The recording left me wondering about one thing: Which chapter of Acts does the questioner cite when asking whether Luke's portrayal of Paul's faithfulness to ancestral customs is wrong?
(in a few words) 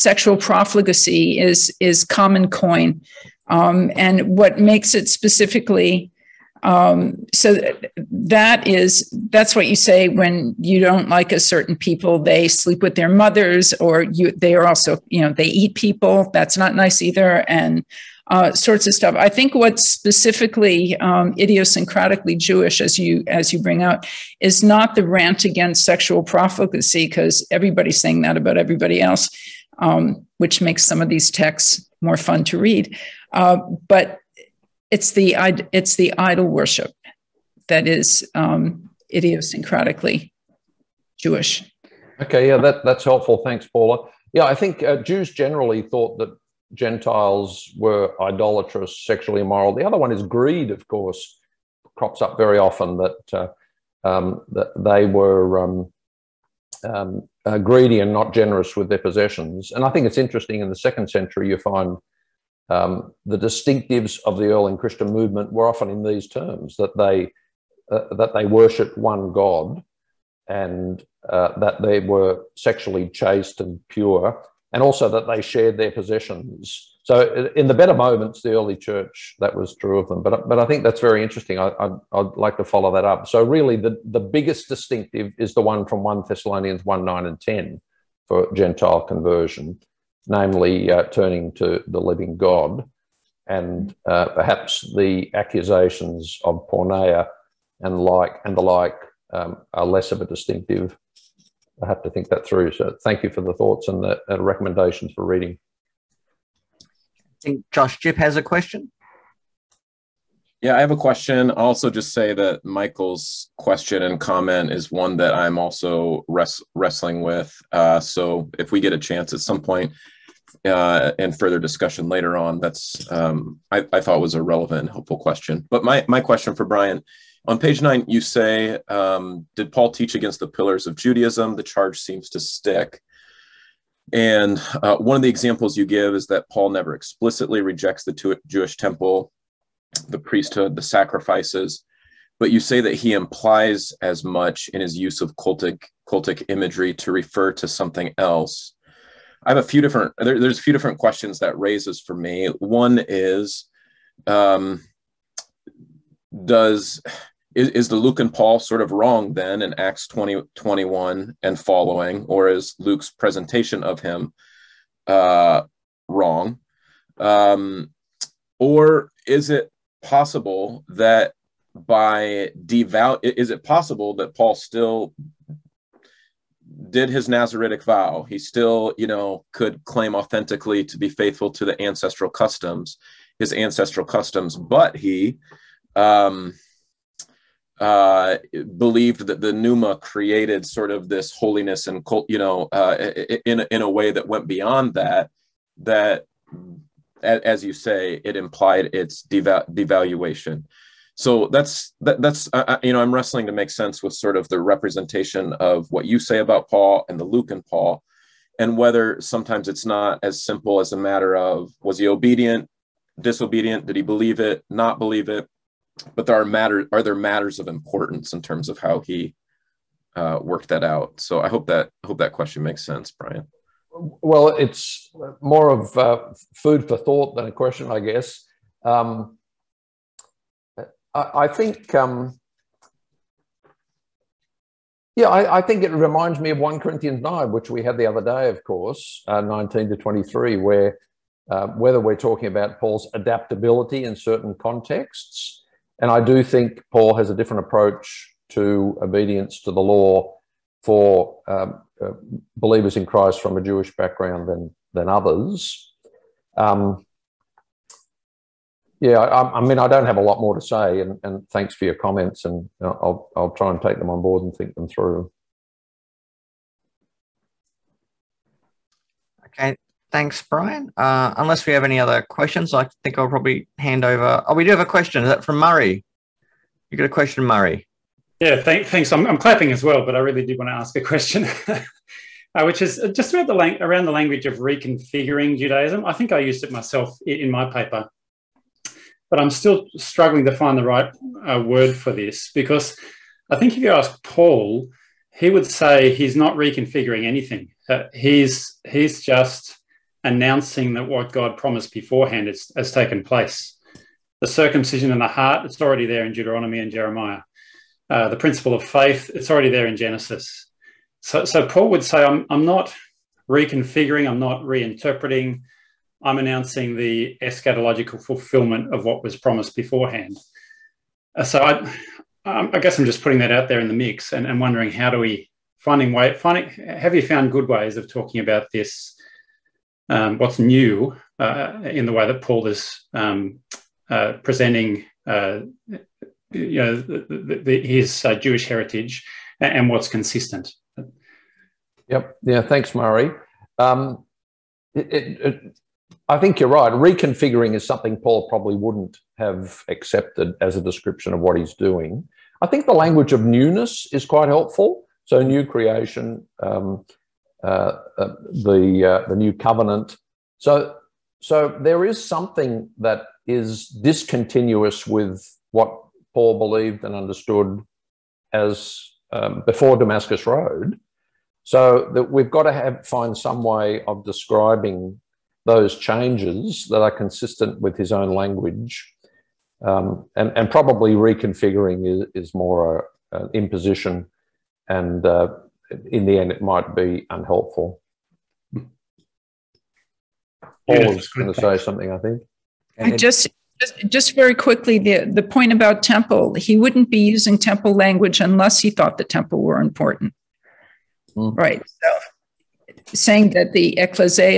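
Acts 20.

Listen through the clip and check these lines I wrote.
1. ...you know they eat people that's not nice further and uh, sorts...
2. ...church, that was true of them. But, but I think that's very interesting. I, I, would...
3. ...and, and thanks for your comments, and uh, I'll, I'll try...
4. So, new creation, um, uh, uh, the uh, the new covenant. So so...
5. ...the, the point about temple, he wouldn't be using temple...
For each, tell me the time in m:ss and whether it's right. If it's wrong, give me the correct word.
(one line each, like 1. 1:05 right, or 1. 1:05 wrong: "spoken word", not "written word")
1. 0:15 wrong: "either", not "further"
2. 1:18 right
3. 4:21 right
4. 5:55 right
5. 6:34 right.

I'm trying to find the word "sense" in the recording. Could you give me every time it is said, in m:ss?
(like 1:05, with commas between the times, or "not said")
3:23, 3:42.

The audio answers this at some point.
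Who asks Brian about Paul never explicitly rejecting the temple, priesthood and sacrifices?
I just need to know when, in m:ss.
1:47.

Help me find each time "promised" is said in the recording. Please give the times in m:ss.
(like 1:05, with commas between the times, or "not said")
5:01, 5:19.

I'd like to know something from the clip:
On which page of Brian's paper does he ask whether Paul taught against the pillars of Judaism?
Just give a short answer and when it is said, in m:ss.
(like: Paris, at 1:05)
9, at 2:07.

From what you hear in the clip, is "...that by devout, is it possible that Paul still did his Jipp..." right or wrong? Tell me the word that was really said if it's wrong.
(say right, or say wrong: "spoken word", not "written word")
wrong: "Nazaritic", not "Jipp".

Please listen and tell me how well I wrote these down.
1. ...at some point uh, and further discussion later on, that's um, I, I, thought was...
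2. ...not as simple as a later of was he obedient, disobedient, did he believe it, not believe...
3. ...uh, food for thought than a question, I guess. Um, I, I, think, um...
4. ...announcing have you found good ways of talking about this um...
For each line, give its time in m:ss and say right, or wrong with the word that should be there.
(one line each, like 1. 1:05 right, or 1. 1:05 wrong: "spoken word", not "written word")
1. 1:59 right
2. 3:29 wrong: "matter", not "later"
3. 3:45 right
4. 5:26 wrong: "finding", not "announcing".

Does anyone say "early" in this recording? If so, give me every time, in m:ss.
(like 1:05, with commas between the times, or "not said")
1:04, 1:18.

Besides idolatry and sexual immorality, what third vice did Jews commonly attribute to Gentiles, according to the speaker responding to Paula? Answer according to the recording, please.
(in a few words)
greed.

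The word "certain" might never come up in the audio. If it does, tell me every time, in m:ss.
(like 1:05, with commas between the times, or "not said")
0:11, 4:04.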